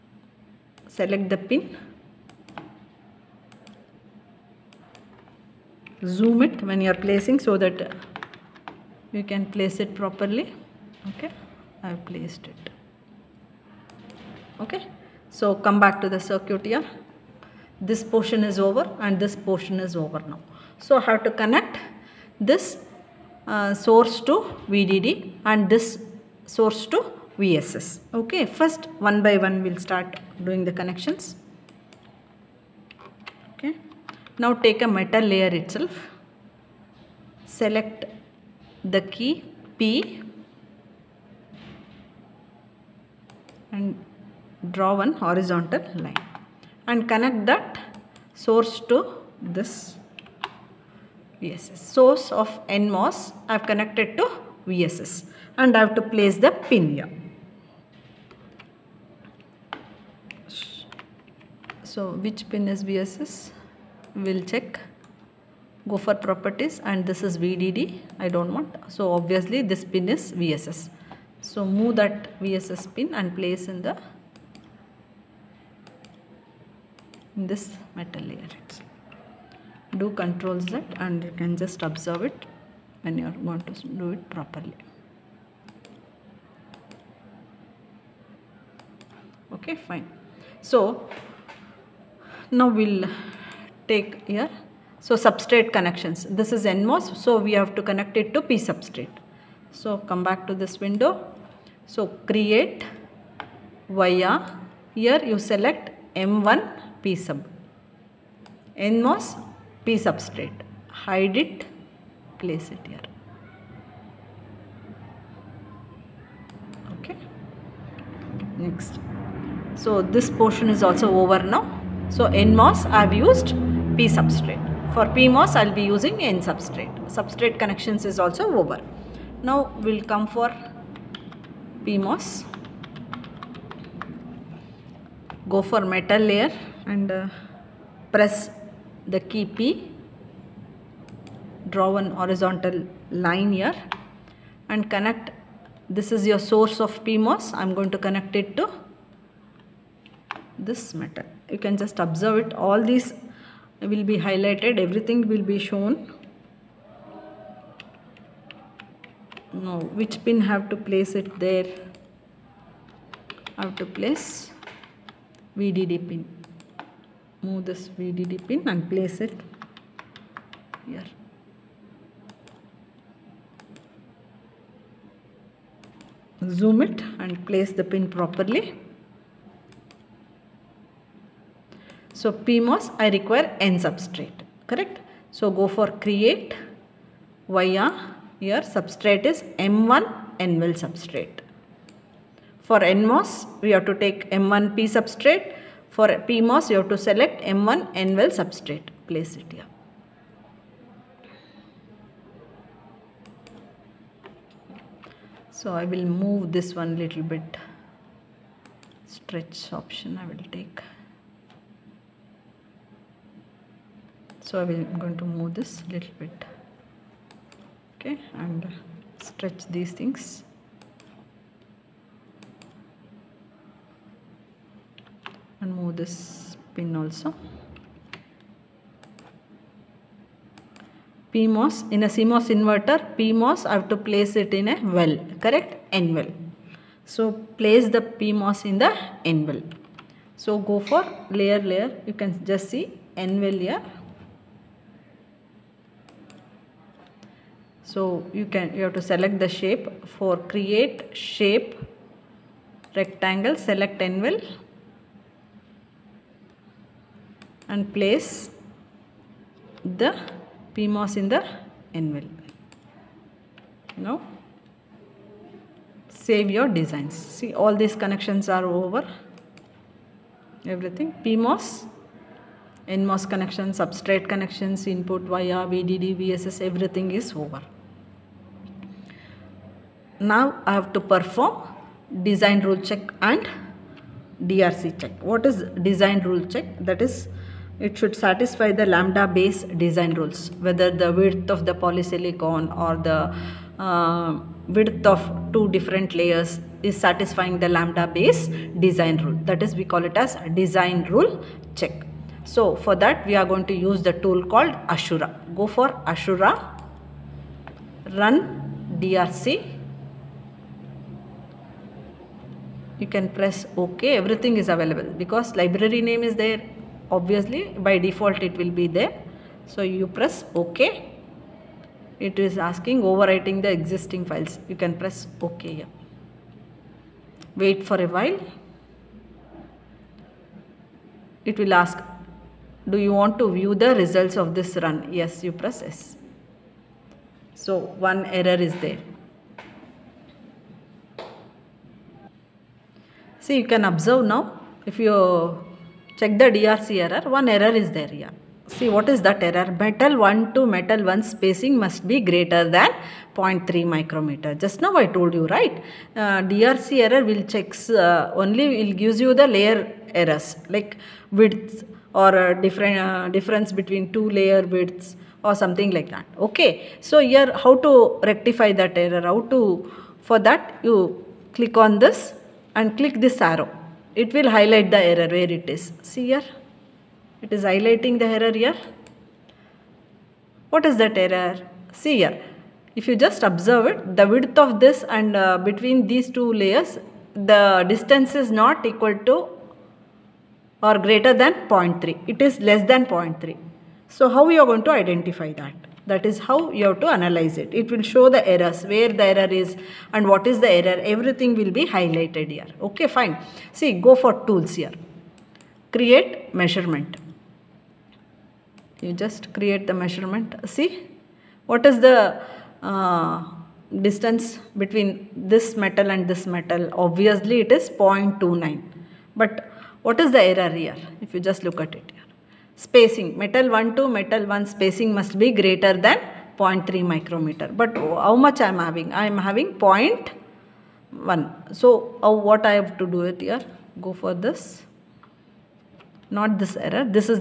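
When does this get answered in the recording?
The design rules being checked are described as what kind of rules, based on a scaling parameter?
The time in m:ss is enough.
4:48.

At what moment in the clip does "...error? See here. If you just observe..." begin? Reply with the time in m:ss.
6:21.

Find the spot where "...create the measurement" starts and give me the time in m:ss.
6:49.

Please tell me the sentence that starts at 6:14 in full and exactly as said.
It will highlight the error where it is.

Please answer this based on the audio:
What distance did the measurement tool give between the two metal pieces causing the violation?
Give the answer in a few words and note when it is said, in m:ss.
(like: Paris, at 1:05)
0.29, at 6:57.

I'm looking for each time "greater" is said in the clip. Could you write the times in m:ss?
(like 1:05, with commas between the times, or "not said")
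5:52, 6:30, 7:05.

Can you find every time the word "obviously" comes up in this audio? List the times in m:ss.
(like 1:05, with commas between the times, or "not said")
1:09, 5:17, 6:56.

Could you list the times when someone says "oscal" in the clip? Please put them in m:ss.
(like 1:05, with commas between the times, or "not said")
not said.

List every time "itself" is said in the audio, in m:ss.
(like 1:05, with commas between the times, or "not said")
0:35.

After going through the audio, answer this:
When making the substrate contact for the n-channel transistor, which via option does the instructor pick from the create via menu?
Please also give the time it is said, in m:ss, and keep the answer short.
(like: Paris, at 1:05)
M1 P sub, at 1:46.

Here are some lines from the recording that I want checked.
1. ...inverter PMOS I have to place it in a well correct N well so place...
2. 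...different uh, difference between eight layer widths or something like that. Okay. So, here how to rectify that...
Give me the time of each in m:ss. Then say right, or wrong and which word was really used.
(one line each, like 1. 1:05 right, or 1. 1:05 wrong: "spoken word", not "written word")
1. 3:52 right
2. 6:02 wrong: "two", not "eight".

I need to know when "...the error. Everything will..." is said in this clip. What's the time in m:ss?
6:40.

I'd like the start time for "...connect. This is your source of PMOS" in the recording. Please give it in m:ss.
2:24.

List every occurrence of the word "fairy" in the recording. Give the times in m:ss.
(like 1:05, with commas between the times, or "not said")
not said.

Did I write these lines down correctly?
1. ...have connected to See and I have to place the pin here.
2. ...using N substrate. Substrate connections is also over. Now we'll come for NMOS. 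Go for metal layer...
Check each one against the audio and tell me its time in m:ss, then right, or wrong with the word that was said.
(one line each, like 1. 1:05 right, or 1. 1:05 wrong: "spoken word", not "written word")
1. 0:53 wrong: "VSS", not "See"
2. 2:05 wrong: "PMOS", not "NMOS".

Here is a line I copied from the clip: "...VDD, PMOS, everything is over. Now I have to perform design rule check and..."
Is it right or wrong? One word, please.
wrong.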